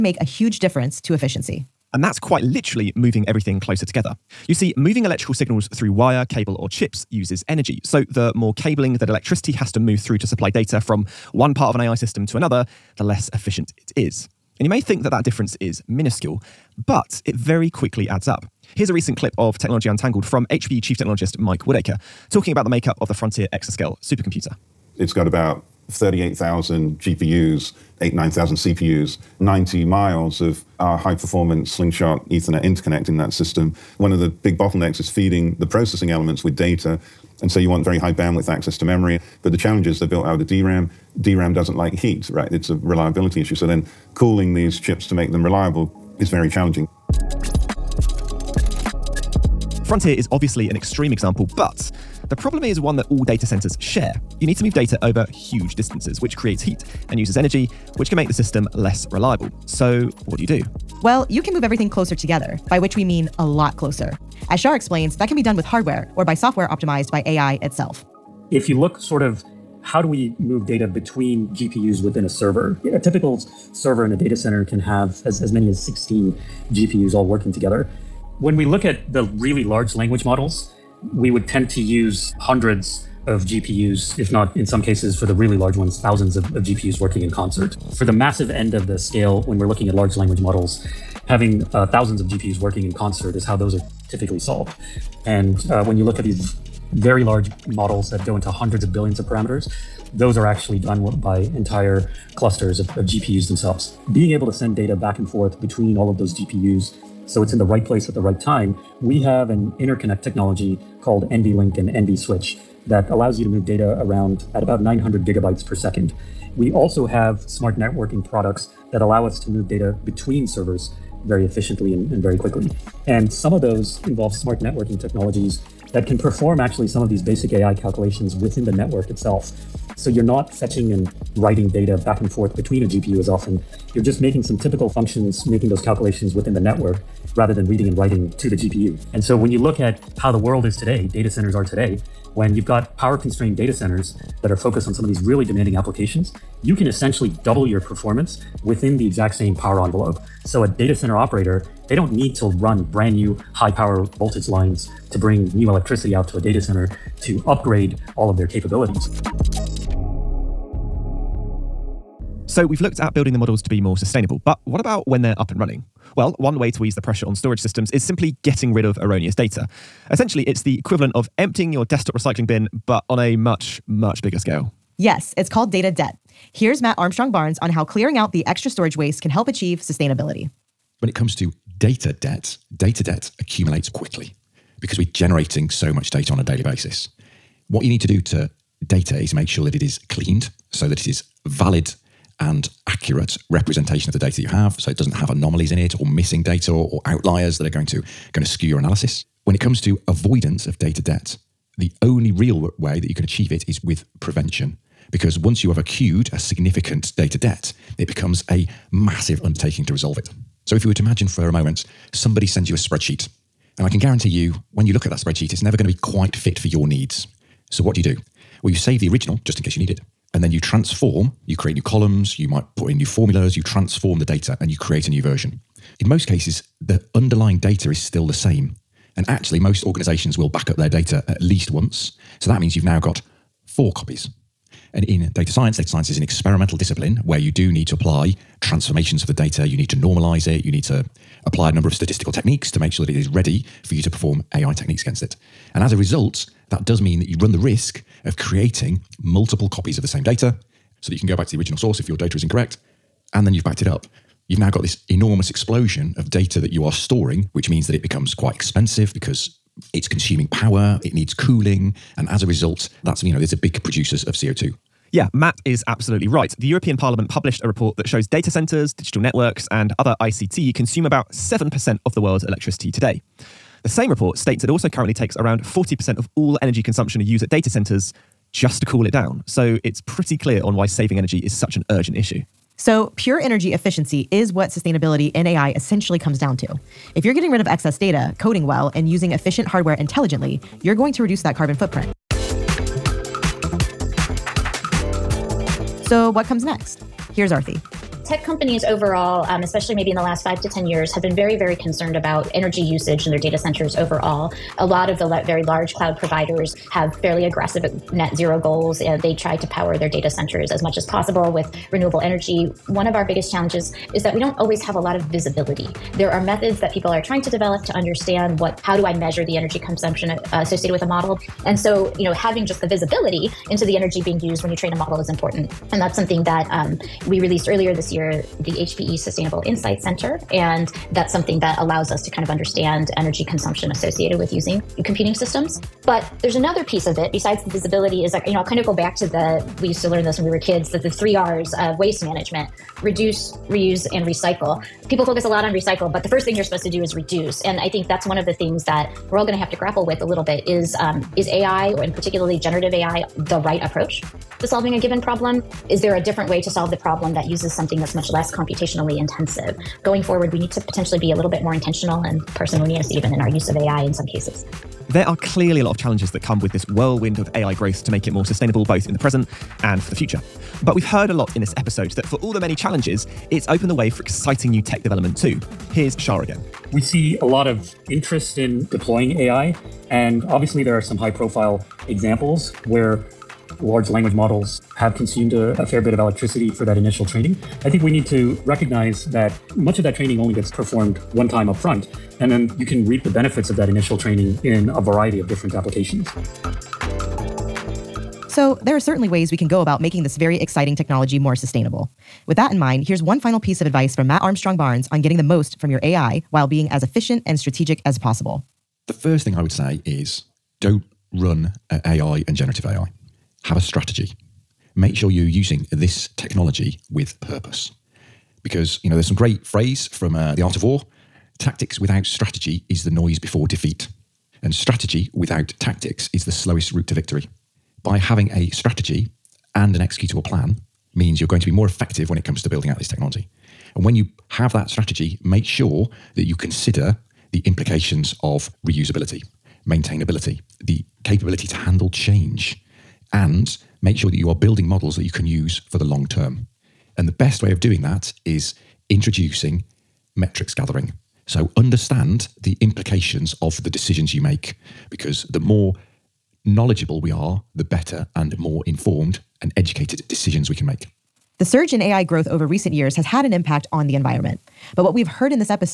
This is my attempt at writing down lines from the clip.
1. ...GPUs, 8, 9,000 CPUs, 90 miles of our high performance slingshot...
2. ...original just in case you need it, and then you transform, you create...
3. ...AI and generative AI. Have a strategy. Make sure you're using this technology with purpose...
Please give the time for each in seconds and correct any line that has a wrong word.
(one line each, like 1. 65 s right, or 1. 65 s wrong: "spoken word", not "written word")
1. 26 s right
2. 219 s right
3. 411 s right.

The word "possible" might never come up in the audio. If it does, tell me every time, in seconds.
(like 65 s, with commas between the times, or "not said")
311 s, 408 s.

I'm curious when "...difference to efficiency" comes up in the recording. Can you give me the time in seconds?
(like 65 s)
0 s.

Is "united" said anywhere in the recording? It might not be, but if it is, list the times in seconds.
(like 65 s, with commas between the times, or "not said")
not said.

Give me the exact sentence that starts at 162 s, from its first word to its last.
So we've looked at building the models to be more sustainable, but what about when they're up and running?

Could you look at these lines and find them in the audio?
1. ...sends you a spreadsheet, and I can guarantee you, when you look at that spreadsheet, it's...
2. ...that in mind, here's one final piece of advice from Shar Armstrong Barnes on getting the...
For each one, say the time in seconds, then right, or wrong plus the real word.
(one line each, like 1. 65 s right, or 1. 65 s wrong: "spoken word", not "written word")
1. 212 s right
2. 402 s wrong: "Matt", not "Shar".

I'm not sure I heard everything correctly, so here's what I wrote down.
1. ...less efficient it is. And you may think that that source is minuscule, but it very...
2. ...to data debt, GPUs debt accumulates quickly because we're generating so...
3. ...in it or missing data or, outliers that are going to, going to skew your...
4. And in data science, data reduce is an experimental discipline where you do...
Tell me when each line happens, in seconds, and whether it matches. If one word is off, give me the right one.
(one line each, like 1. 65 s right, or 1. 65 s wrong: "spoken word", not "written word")
1. 13 s wrong: "difference", not "source"
2. 181 s wrong: "Data", not "GPUs"
3. 195 s right
4. 234 s wrong: "science", not "reduce".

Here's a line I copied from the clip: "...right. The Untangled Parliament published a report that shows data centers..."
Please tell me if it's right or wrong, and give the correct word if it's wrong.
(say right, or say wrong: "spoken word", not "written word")
wrong: "European", not "Untangled".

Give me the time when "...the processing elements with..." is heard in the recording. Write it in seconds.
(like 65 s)
35 s.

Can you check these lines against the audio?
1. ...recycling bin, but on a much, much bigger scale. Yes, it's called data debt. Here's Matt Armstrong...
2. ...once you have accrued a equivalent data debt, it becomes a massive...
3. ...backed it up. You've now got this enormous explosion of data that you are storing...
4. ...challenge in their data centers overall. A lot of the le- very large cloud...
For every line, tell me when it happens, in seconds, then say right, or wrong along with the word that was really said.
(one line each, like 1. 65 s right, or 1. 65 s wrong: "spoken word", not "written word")
1. 172 s right
2. 205 s wrong: "significant", not "equivalent"
3. 253 s right
4. 302 s wrong: "usage", not "challenge".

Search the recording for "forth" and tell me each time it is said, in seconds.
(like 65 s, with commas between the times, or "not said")
105 s, 132 s.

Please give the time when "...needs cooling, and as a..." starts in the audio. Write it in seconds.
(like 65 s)
261 s.